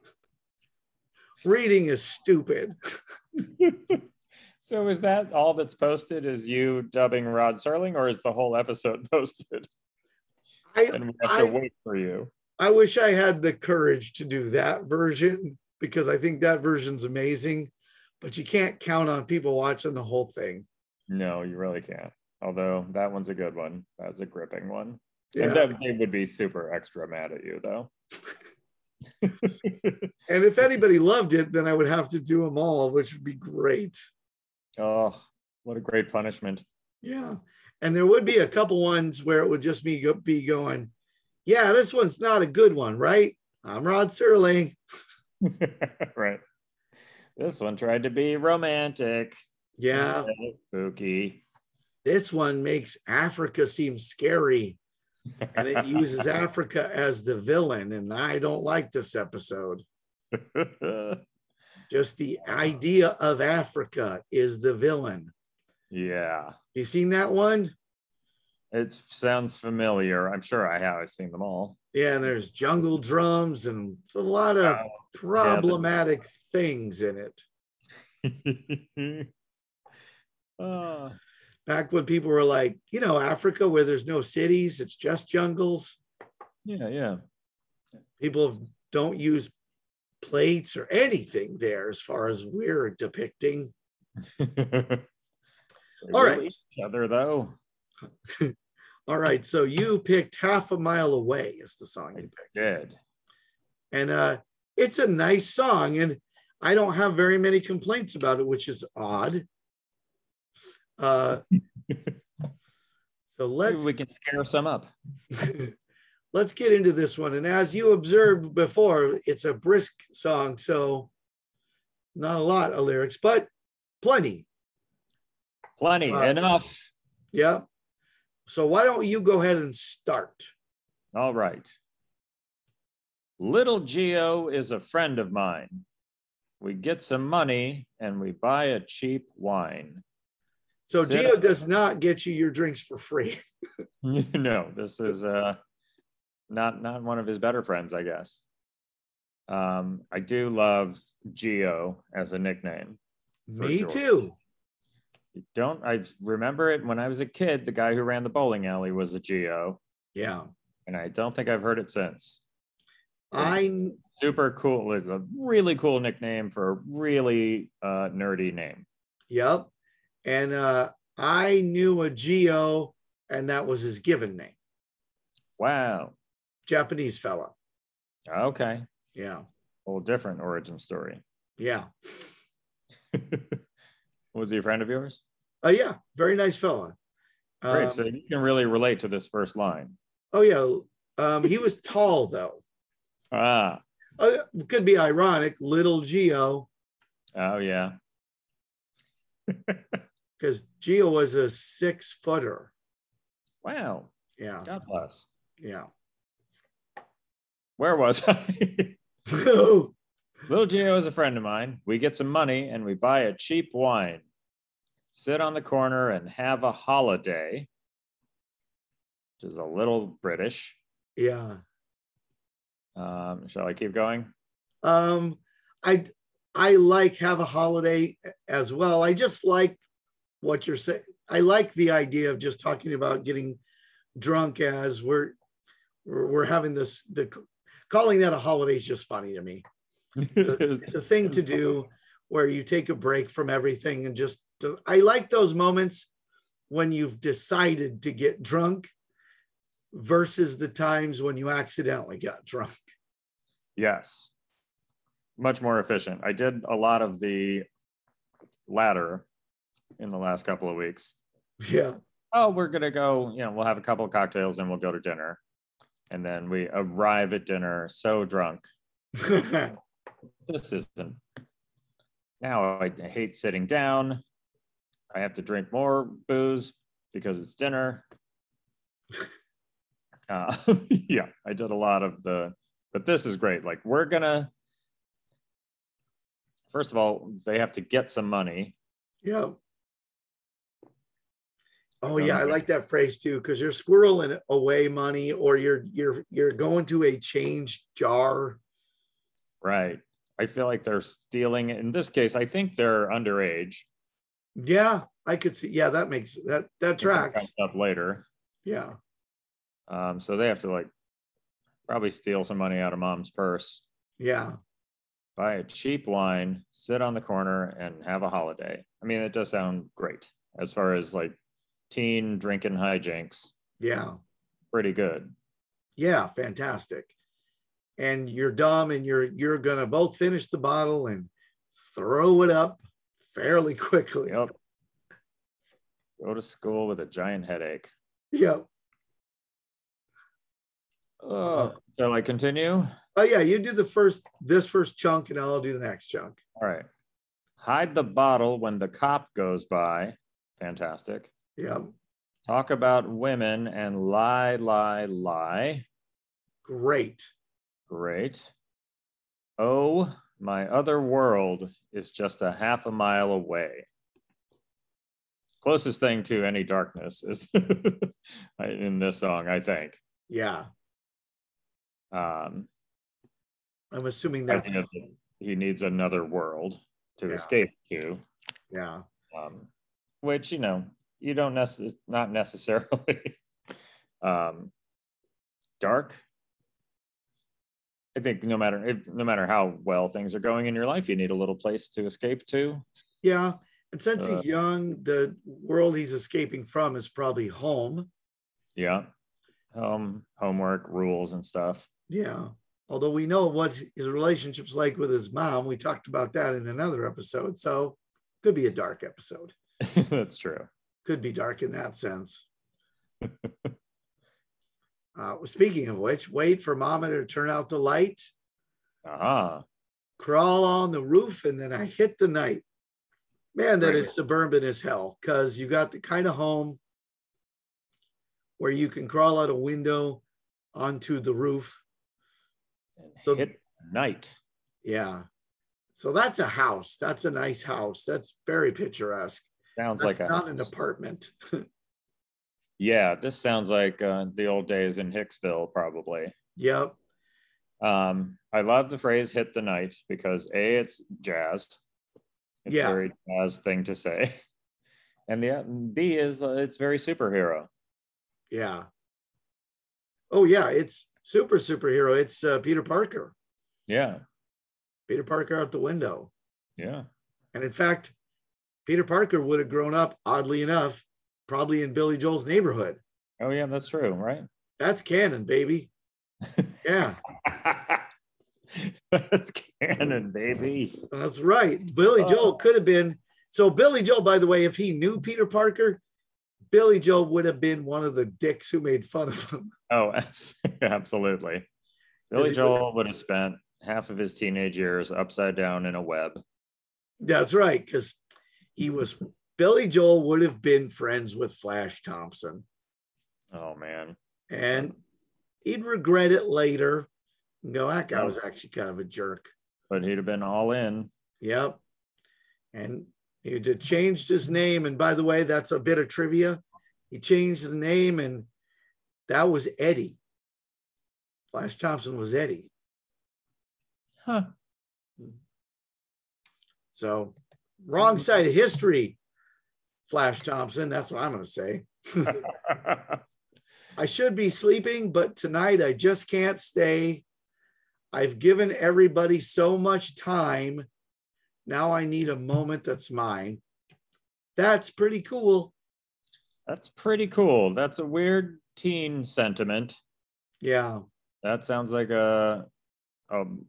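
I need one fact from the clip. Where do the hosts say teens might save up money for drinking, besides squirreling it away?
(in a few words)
a change jar.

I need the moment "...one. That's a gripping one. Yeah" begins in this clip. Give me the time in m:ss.
0:23.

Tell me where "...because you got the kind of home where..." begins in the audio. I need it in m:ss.
7:05.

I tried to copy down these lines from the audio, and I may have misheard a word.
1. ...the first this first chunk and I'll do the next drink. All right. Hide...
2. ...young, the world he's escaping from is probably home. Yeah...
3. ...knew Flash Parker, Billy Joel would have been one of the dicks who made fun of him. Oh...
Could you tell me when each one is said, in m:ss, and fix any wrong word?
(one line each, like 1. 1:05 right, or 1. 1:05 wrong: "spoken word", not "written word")
1. 5:43 wrong: "chunk", not "drink"
2. 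6:34 right
3. 8:04 wrong: "Peter", not "Flash".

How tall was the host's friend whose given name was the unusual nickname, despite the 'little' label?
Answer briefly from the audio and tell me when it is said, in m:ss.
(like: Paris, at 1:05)
six footer, at 3:21.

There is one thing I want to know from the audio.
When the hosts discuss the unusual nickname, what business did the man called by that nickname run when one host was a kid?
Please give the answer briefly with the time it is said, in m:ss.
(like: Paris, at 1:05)
bowling alley, at 2:38.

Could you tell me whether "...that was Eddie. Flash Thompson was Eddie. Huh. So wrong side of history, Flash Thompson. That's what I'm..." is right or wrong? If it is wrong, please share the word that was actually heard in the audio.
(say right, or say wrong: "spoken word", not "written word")
right.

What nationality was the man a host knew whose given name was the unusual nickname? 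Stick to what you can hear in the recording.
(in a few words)
Japanese.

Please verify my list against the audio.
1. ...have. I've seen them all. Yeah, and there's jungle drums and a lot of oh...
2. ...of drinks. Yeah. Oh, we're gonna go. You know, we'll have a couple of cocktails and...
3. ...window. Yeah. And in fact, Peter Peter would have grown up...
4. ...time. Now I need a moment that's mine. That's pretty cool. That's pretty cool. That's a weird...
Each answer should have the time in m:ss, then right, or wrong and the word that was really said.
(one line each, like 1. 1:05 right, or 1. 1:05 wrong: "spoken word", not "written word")
1. 1:10 right
2. 4:20 wrong: "weeks", not "drinks"
3. 7:45 wrong: "Parker", not "Peter"
4. 9:00 right.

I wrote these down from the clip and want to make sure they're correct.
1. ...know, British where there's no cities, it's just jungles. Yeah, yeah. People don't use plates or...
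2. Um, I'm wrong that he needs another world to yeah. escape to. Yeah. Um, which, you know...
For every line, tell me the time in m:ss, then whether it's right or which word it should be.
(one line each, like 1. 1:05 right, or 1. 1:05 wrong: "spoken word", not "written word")
1. 1:22 wrong: "Africa", not "British"
2. 6:12 wrong: "assuming", not "wrong".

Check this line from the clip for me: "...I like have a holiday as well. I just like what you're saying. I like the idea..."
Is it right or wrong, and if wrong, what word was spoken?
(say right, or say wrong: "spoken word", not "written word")
right.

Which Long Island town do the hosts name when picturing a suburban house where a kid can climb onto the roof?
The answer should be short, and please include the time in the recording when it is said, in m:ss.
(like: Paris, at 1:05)
Hicksville, at 7:25.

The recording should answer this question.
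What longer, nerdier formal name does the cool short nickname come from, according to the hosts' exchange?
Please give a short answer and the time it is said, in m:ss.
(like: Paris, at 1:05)
George, at 2:33.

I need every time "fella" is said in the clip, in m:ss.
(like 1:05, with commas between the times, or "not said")
2:57, 3:06.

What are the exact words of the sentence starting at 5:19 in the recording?
I mean, it does sound great as far as like teen drinking hijinks.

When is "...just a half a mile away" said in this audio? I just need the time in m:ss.
6:02.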